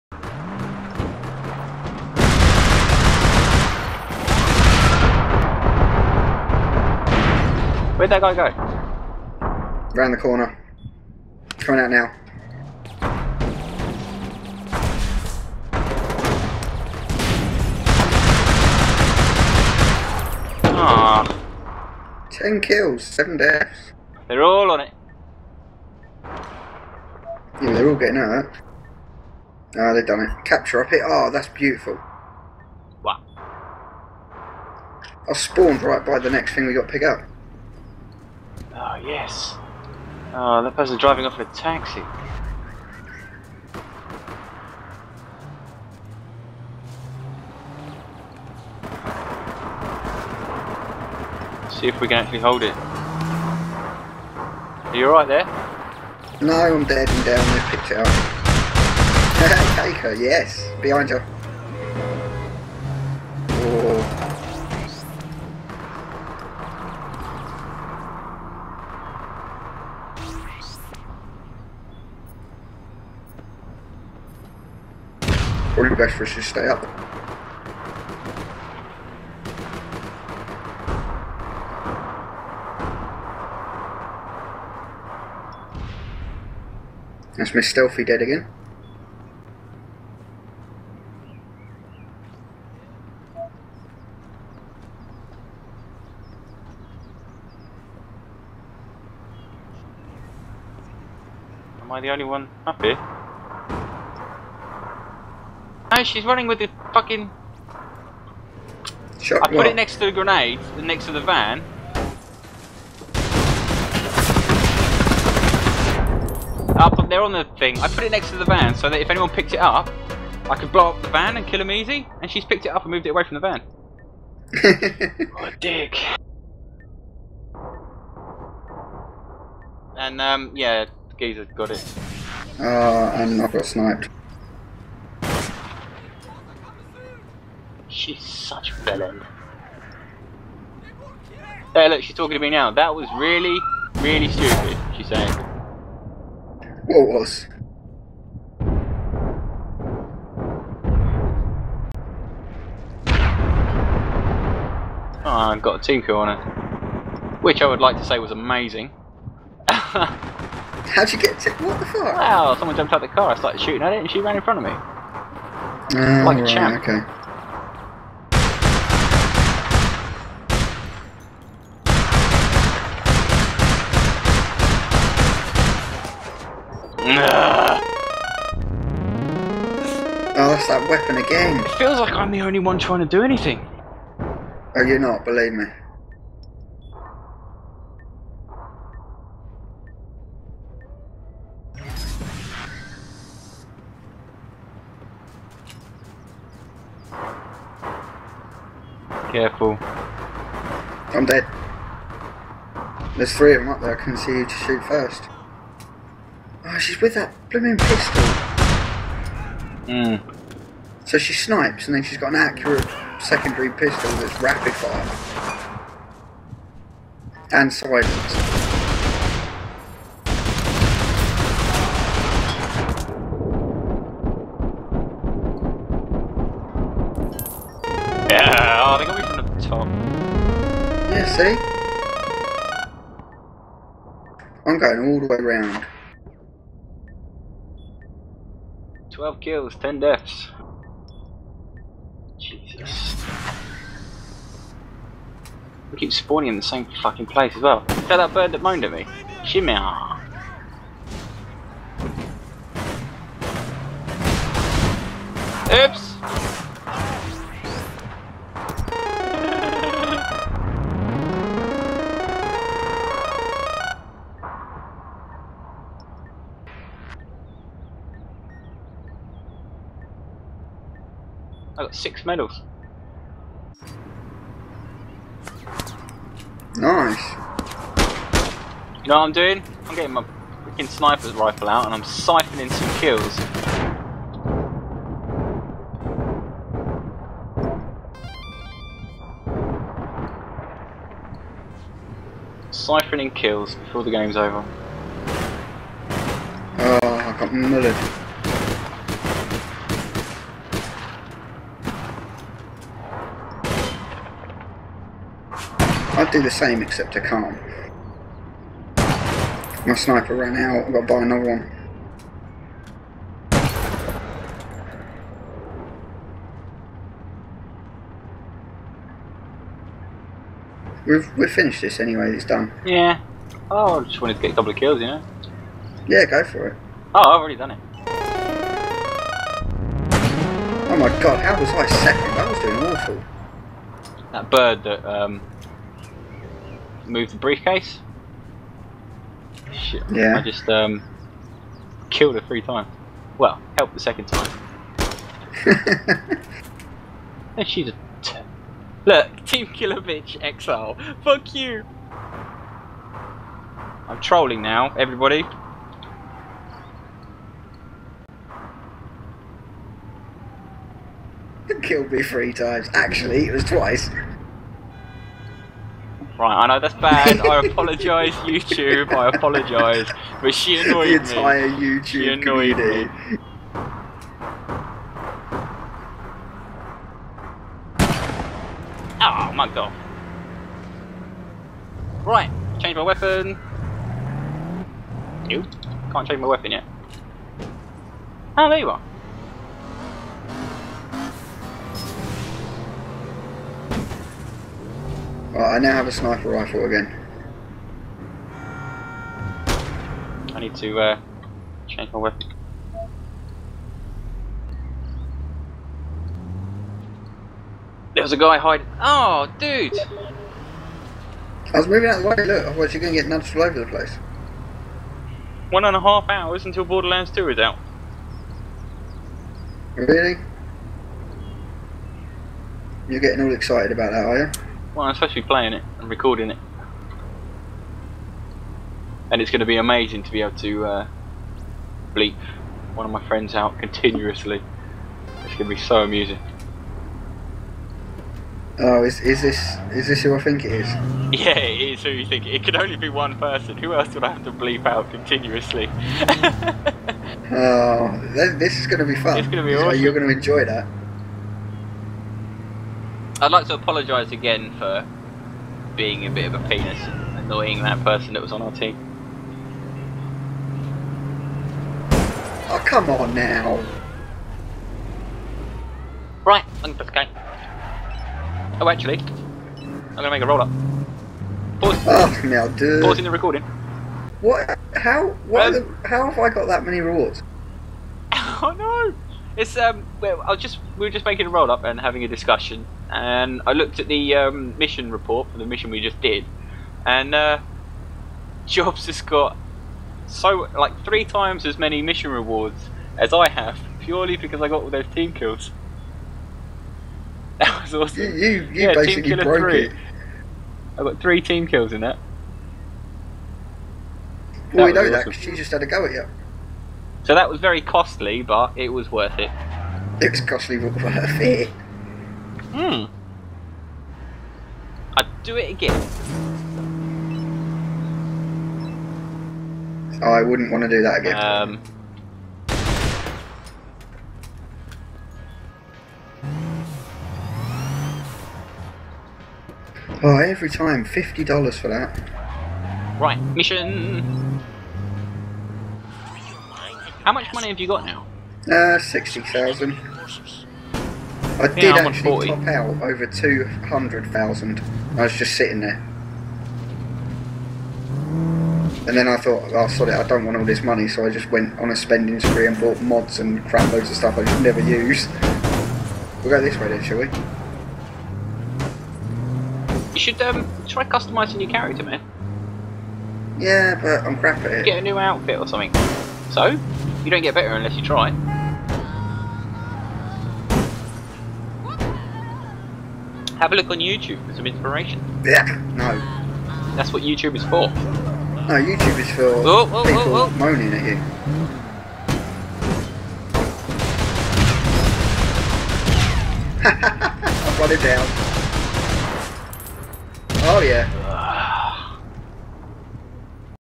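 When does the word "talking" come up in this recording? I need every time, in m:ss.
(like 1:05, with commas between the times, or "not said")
2:22.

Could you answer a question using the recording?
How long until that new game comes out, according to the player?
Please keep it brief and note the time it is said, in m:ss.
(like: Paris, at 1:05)
1.5 hours, at 6:55.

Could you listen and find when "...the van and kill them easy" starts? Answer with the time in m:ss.
2:01.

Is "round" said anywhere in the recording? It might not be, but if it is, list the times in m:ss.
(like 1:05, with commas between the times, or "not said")
0:09, 3:55.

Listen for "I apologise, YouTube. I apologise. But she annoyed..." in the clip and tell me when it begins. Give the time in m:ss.
6:07.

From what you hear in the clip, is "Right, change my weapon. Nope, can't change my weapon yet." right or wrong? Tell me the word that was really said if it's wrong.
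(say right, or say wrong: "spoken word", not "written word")
right.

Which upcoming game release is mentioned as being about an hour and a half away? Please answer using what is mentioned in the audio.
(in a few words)
Borderlands 2.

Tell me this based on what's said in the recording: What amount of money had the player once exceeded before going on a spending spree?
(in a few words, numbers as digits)
200,000.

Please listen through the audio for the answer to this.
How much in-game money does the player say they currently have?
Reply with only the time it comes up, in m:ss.
8:58.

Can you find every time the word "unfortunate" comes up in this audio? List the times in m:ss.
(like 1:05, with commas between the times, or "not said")
not said.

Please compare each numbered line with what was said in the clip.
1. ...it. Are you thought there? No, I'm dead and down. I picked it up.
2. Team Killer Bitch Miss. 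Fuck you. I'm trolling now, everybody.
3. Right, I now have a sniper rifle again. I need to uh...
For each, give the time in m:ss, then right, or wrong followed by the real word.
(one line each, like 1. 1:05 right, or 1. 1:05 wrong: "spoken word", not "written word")
1. 0:52 wrong: "alright", not "thought"
2. 5:49 wrong: "Exile", not "Miss"
3. 6:35 right.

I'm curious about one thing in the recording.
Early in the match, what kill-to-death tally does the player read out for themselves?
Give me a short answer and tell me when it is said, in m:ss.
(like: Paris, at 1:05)
10 kills, 7 deaths, at 0:22.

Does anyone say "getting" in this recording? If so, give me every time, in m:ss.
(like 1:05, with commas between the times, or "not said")
0:27, 4:39, 7:03.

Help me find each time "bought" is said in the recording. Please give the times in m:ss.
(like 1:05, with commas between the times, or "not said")
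9:12.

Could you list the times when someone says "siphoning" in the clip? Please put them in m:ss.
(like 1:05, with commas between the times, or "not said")
4:42, 4:52.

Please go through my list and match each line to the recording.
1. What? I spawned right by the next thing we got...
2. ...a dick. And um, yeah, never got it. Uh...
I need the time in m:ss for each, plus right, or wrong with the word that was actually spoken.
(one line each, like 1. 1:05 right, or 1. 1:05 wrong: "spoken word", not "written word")
1. 0:33 right
2. 2:05 wrong: "geezer", not "never".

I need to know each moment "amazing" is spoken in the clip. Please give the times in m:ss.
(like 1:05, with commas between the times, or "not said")
2:38, 7:09.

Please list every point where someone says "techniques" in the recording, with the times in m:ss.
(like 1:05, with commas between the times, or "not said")
not said.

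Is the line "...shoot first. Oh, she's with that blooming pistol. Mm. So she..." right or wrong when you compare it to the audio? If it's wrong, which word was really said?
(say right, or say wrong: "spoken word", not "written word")
right.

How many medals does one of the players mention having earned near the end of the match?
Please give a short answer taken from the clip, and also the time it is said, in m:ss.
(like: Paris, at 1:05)
6, at 4:31.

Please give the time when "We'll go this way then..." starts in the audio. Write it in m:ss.
9:16.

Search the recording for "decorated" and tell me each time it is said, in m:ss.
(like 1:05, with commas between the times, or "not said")
not said.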